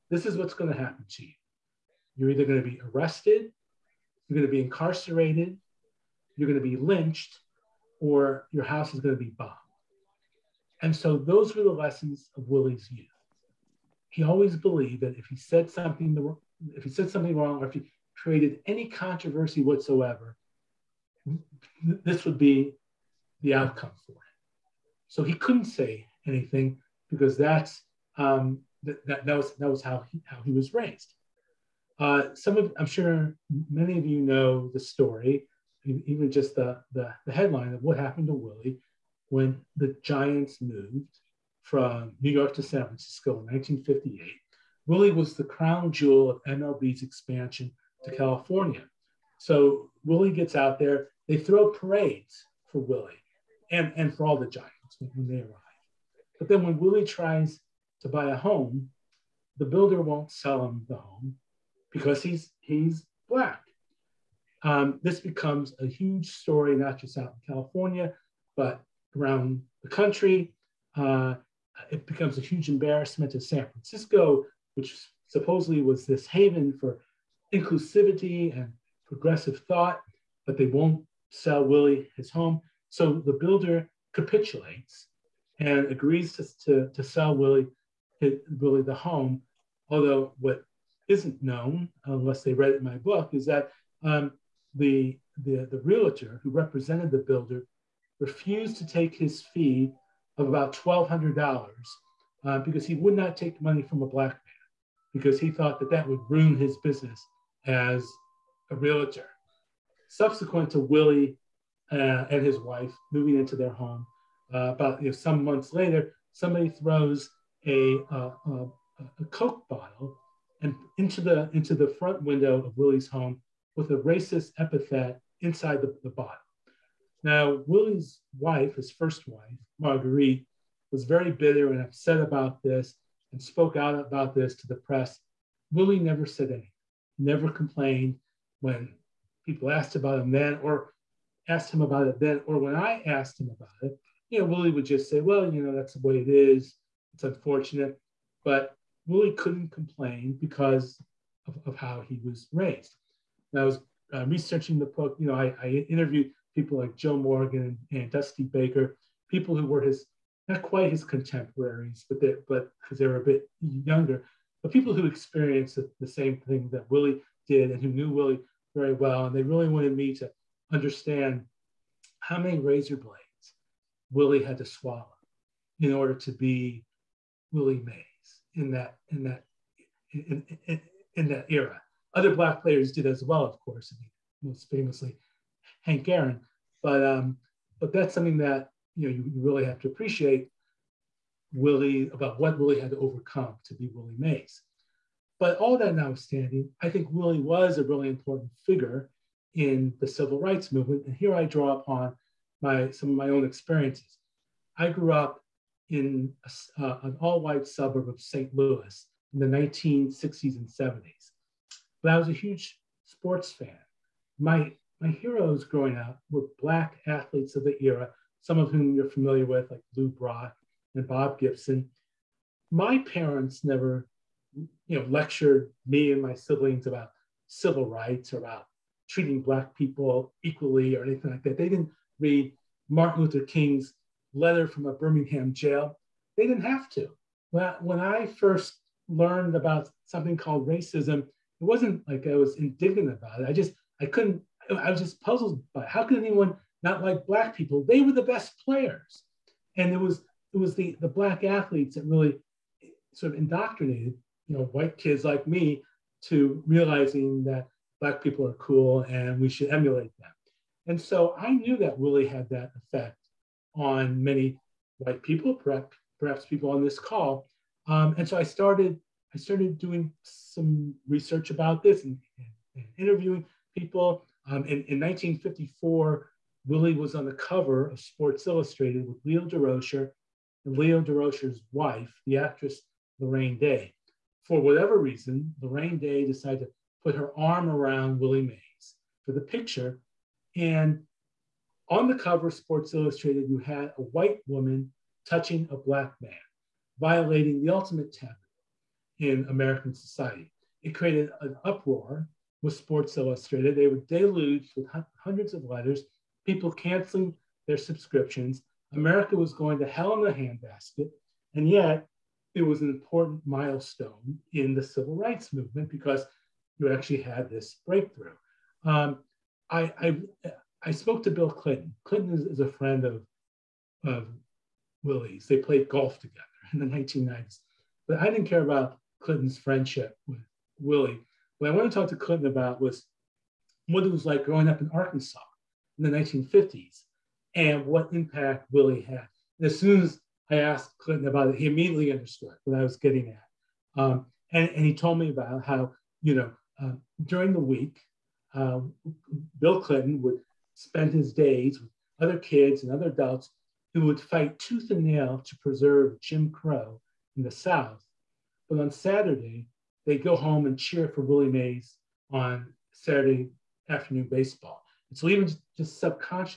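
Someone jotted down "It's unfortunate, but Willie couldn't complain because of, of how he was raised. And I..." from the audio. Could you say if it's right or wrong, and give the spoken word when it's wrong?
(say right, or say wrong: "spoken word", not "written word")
right.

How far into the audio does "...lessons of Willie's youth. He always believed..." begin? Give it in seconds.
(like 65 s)
11 s.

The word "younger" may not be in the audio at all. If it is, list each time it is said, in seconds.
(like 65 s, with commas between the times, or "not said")
163 s.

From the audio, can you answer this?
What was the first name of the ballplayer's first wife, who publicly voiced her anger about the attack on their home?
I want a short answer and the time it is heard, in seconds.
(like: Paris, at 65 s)
Marguerite, at 129 s.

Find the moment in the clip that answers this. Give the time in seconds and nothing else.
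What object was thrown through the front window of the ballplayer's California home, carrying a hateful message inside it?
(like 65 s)
119 s.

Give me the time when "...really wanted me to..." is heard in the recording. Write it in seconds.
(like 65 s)
169 s.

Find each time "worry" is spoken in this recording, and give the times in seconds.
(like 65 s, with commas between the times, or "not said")
not said.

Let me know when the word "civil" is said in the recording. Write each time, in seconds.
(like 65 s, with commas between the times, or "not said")
200 s, 227 s, 314 s.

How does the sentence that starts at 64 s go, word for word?
Um, this becomes a huge story, not just out in California, but around the country.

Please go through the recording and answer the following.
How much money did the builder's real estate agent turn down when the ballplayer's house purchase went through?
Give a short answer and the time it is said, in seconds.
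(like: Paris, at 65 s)
$1,200, at 100 s.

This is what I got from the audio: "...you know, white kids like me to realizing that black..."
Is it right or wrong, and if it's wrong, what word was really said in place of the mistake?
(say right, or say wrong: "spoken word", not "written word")
right.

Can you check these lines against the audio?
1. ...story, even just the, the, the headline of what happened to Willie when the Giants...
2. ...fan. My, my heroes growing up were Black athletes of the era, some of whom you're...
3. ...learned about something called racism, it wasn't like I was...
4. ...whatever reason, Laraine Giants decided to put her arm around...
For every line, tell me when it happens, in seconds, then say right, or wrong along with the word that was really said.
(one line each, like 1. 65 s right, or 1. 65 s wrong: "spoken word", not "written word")
1. 34 s right
2. 213 s right
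3. 239 s right
4. 284 s wrong: "Day", not "Giants".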